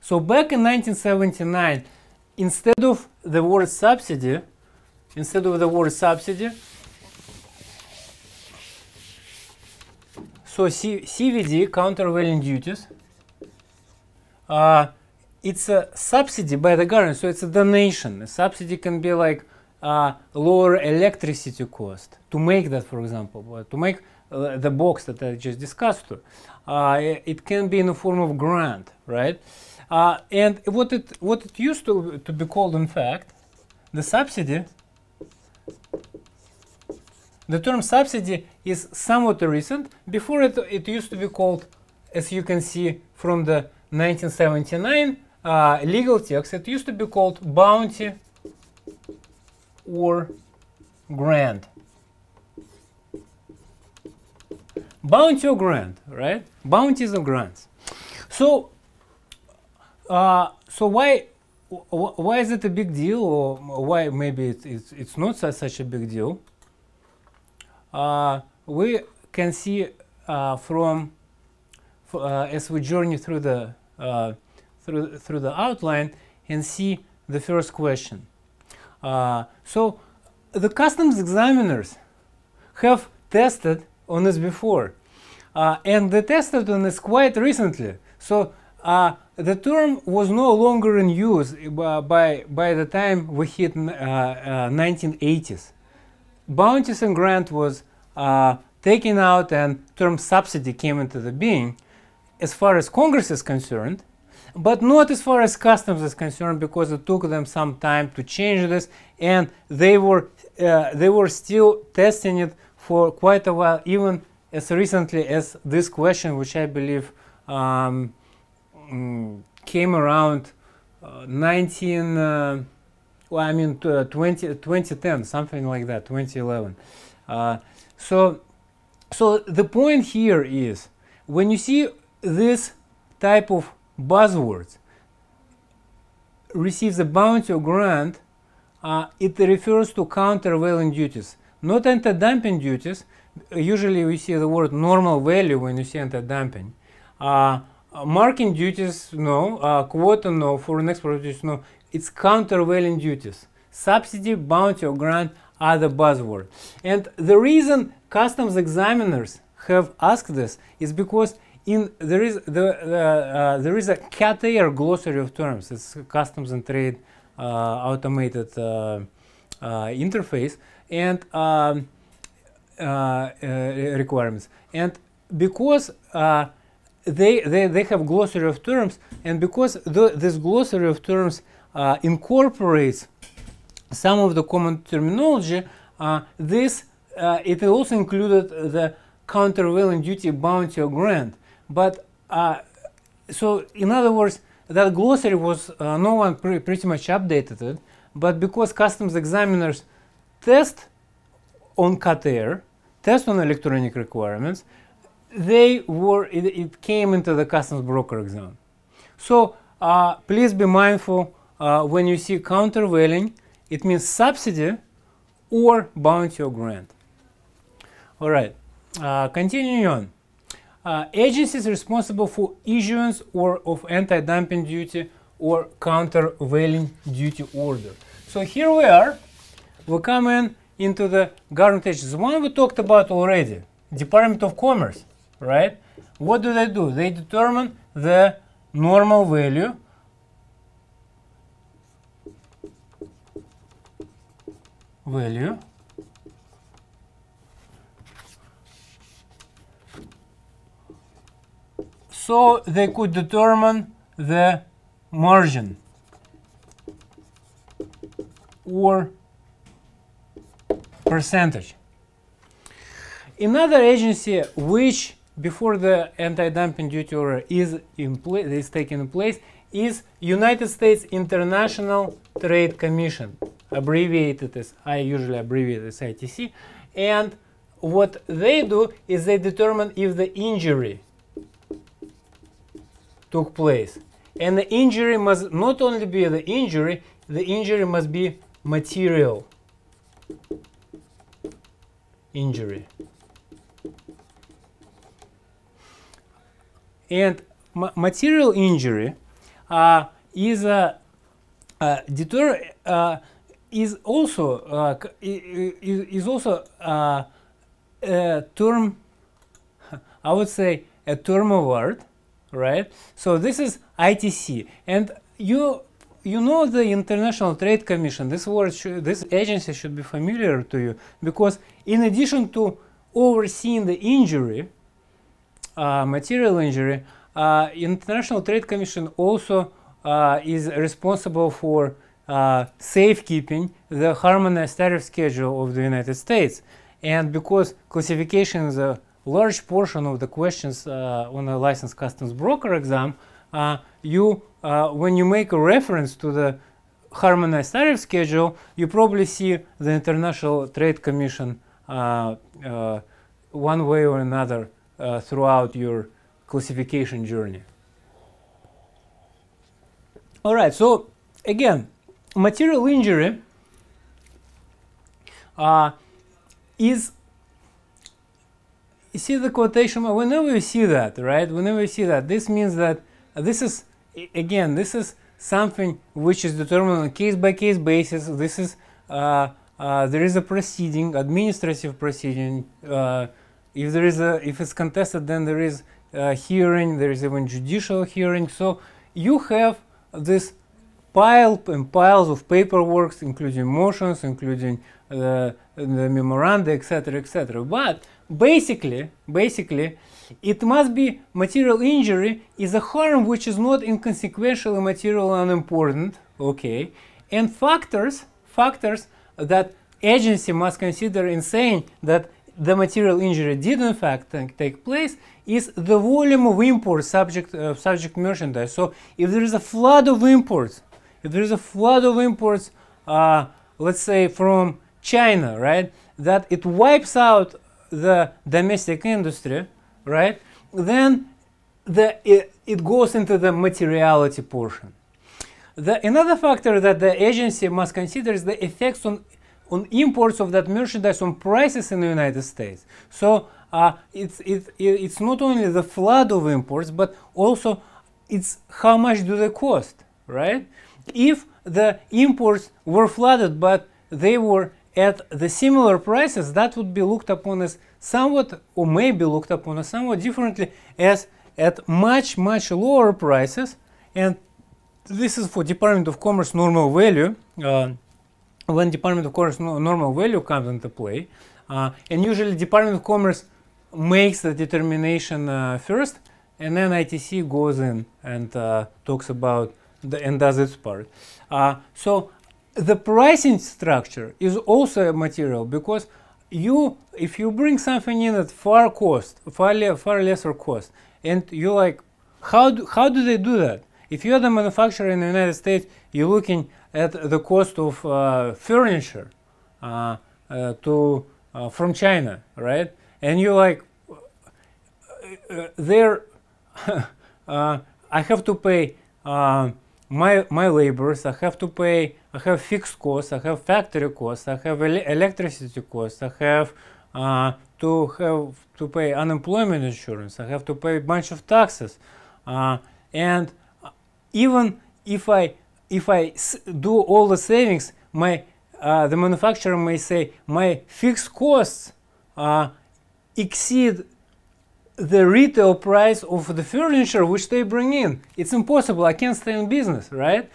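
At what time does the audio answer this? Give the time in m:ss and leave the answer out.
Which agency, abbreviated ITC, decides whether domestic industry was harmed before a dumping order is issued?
4:30.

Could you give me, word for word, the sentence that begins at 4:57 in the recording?
And material injury uh, is a, uh, a uh, deter uh, is also uh, is, also uh, a term.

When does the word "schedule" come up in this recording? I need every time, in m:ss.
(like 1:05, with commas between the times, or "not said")
5:35, 5:47.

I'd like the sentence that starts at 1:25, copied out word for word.
Uh, and they tested on this quite recently.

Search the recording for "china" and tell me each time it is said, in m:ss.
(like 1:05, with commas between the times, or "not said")
7:05, 8:21.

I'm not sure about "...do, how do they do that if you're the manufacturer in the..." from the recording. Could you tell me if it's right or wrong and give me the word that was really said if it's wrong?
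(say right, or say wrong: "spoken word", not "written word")
right.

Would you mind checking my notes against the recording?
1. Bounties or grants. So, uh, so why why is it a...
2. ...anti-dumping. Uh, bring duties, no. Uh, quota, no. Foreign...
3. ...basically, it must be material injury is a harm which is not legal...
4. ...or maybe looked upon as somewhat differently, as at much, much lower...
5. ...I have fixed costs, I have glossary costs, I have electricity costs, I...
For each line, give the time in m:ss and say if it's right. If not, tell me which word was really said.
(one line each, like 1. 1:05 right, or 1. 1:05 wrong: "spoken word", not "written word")
1. 0:56 right
2. 2:25 wrong: "marking", not "bring"
3. 6:39 wrong: "inconsequential", not "legal"
4. 7:38 right
5. 8:32 wrong: "factory", not "glossary".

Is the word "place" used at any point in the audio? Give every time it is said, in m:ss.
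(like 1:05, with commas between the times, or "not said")
4:29, 4:43, 6:54.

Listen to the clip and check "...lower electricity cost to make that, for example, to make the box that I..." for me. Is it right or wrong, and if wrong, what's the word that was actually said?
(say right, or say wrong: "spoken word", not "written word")
right.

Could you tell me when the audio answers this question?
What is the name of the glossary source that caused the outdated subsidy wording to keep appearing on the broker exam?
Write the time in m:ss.
2:43.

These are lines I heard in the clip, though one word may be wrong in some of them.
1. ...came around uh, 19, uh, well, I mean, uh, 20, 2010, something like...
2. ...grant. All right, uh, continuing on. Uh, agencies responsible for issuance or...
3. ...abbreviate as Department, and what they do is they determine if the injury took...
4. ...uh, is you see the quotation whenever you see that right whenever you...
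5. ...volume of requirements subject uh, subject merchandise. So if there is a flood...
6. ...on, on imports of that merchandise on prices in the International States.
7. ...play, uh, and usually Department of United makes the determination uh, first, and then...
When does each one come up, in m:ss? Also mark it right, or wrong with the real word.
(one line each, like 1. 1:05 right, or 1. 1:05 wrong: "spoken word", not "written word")
1. 1:59 right
2. 3:36 right
3. 4:35 wrong: "ITC", not "Department"
4. 6:05 right
5. 6:55 wrong: "imports", not "requirements"
6. 7:19 wrong: "United", not "International"
7. 7:50 wrong: "Commerce", not "United".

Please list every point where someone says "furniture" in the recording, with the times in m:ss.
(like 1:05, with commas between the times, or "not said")
8:18, 8:56.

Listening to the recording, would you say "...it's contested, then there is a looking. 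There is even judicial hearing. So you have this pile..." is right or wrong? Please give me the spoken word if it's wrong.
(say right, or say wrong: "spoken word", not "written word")
wrong: "hearing", not "looking".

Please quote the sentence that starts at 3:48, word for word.
So here we are we come in into the government agencies.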